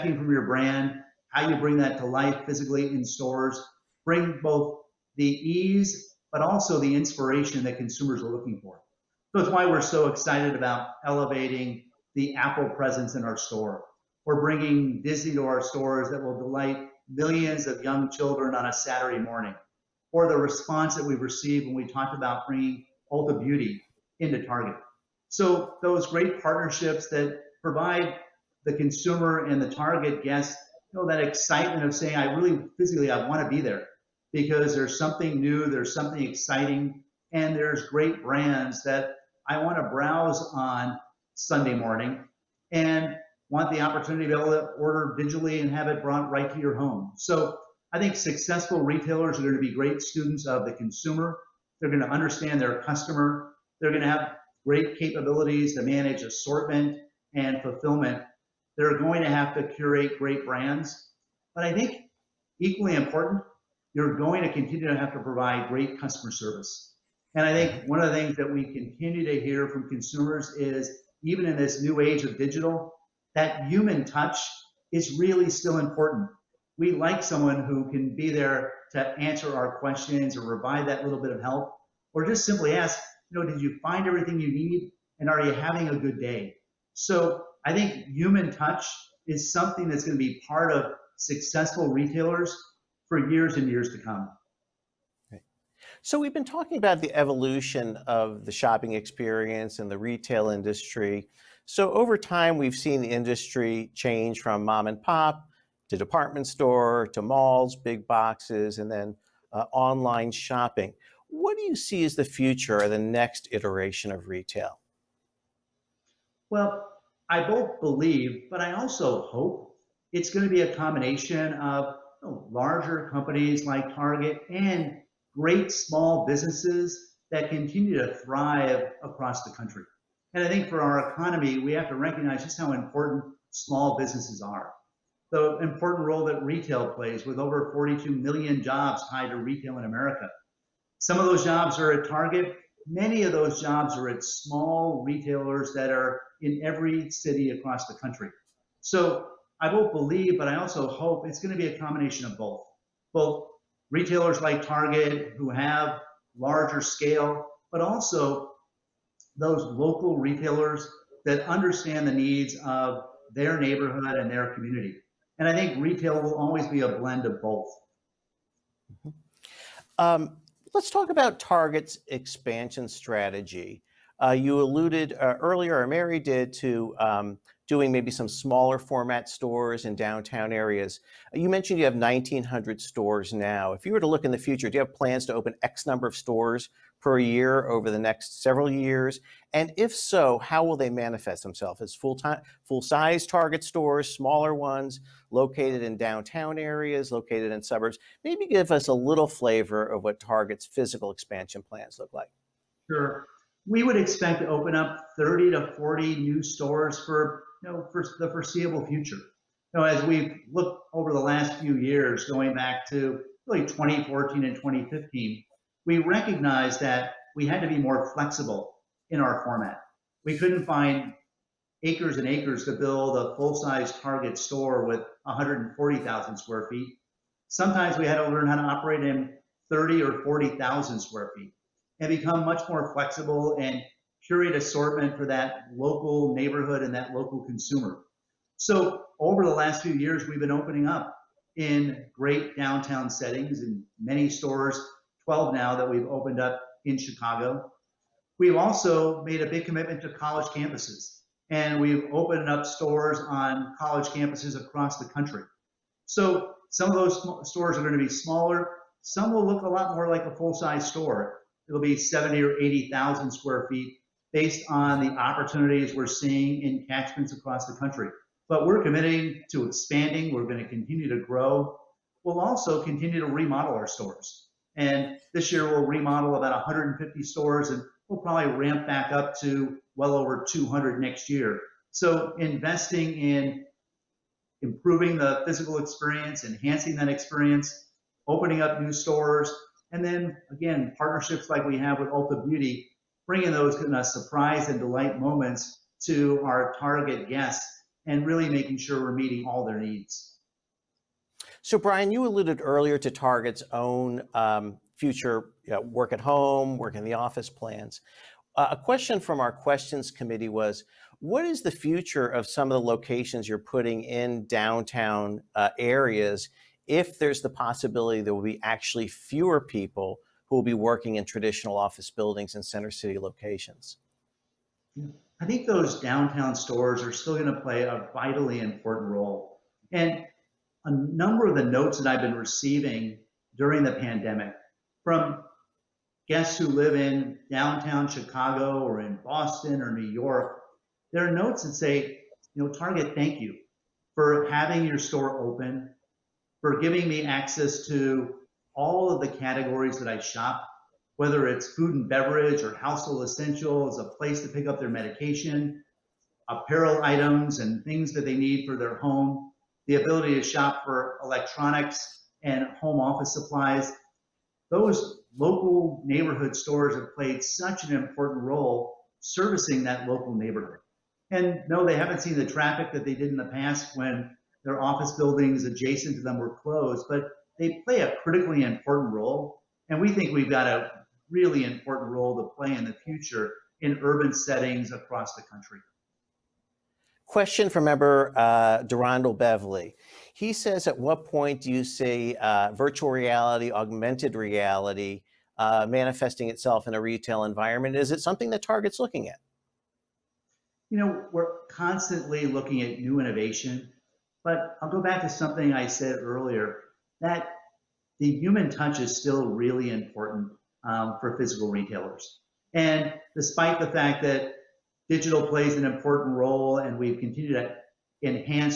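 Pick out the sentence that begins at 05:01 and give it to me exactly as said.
So, Brian, you alluded earlier to Target's own um, future you know, work at home, work in the office plans.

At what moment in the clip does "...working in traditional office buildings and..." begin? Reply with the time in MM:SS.
05:20.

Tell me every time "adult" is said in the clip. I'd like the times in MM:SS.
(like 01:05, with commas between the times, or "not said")
not said.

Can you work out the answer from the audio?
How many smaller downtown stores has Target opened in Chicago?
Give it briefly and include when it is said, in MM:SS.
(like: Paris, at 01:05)
12, at 04:05.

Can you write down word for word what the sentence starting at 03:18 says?
Maybe give us a little flavor of what Target's physical expansion plans look like.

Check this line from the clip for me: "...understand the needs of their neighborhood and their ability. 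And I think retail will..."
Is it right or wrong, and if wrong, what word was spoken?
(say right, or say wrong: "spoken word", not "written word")
wrong: "community", not "ability".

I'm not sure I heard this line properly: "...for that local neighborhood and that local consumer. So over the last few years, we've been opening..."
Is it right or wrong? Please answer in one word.
right.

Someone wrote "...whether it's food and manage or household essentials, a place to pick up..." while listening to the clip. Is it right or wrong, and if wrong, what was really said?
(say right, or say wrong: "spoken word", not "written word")
wrong: "beverage", not "manage".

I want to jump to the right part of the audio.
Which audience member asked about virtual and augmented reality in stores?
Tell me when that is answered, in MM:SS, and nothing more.
06:28.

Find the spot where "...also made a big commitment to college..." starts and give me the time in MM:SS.
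04:08.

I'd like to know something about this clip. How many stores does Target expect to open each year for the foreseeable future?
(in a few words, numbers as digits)
30 to 40.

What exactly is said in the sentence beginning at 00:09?
So it's why we're so excited about elevating the Apple presence in our store.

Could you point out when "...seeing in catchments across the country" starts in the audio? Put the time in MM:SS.
04:26.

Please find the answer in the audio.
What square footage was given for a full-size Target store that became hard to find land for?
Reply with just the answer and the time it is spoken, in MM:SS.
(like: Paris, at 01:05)
140,000 square feet, at 03:45.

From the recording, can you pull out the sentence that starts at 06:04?
Those local neighborhood stores have played such an important role servicing that local neighborhood.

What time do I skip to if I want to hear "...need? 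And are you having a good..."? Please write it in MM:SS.
01:24.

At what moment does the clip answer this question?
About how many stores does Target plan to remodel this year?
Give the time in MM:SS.
04:36.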